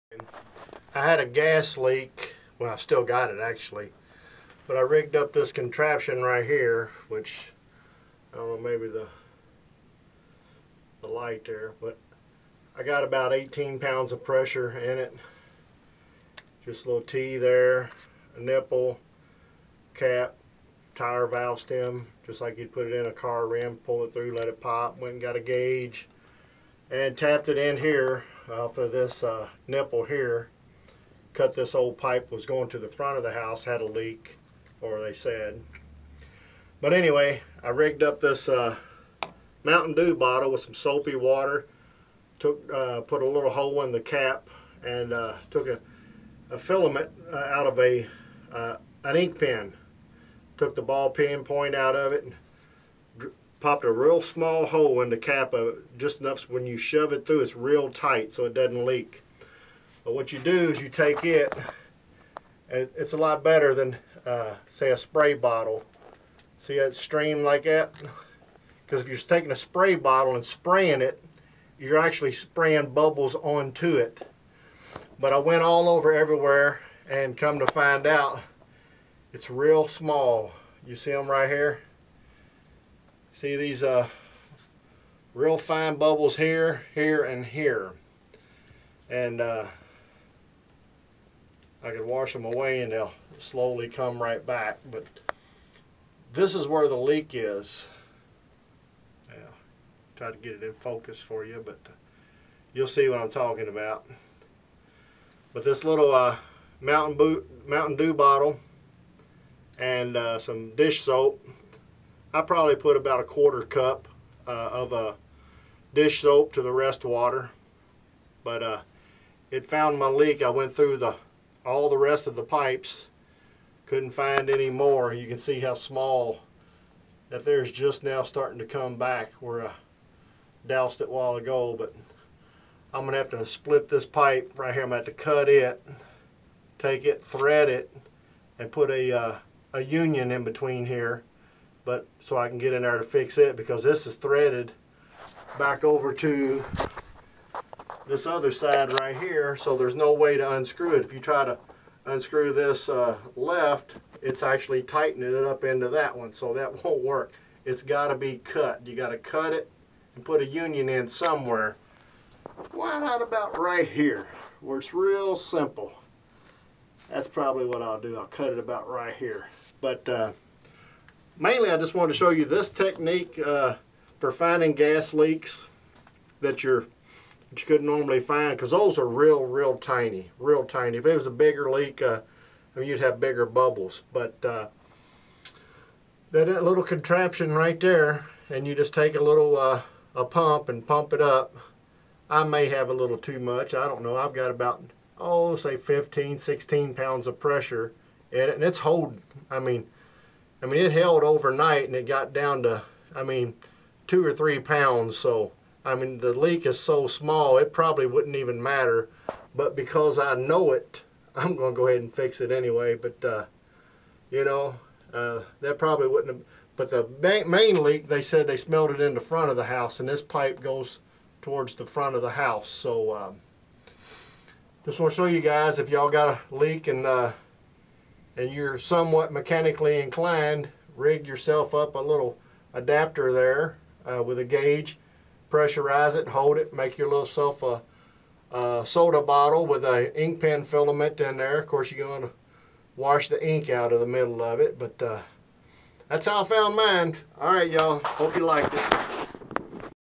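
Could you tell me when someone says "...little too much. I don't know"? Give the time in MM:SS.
03:12.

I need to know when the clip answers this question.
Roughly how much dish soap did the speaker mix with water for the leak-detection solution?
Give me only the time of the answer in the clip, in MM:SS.
01:52.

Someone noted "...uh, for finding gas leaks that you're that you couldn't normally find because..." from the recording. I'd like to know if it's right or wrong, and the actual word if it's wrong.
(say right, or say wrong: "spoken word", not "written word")
right.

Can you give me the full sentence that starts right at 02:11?
But I'm going to have to split this pipe right here.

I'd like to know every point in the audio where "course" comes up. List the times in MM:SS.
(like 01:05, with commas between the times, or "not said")
04:01.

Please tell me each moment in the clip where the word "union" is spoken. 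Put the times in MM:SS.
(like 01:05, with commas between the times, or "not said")
02:19, 02:40.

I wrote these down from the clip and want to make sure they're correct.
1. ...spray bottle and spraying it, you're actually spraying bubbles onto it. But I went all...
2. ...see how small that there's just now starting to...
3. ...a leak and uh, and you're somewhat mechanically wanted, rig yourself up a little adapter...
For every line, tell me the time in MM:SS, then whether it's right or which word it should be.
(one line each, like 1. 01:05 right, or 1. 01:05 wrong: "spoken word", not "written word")
1. 01:09 right
2. 02:05 right
3. 03:46 wrong: "inclined", not "wanted".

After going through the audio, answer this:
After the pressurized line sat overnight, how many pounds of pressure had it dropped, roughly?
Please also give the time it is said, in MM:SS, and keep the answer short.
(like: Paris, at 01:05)
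2 or 3 pounds, at 03:24.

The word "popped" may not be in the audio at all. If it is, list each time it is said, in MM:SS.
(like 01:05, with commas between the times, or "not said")
00:53.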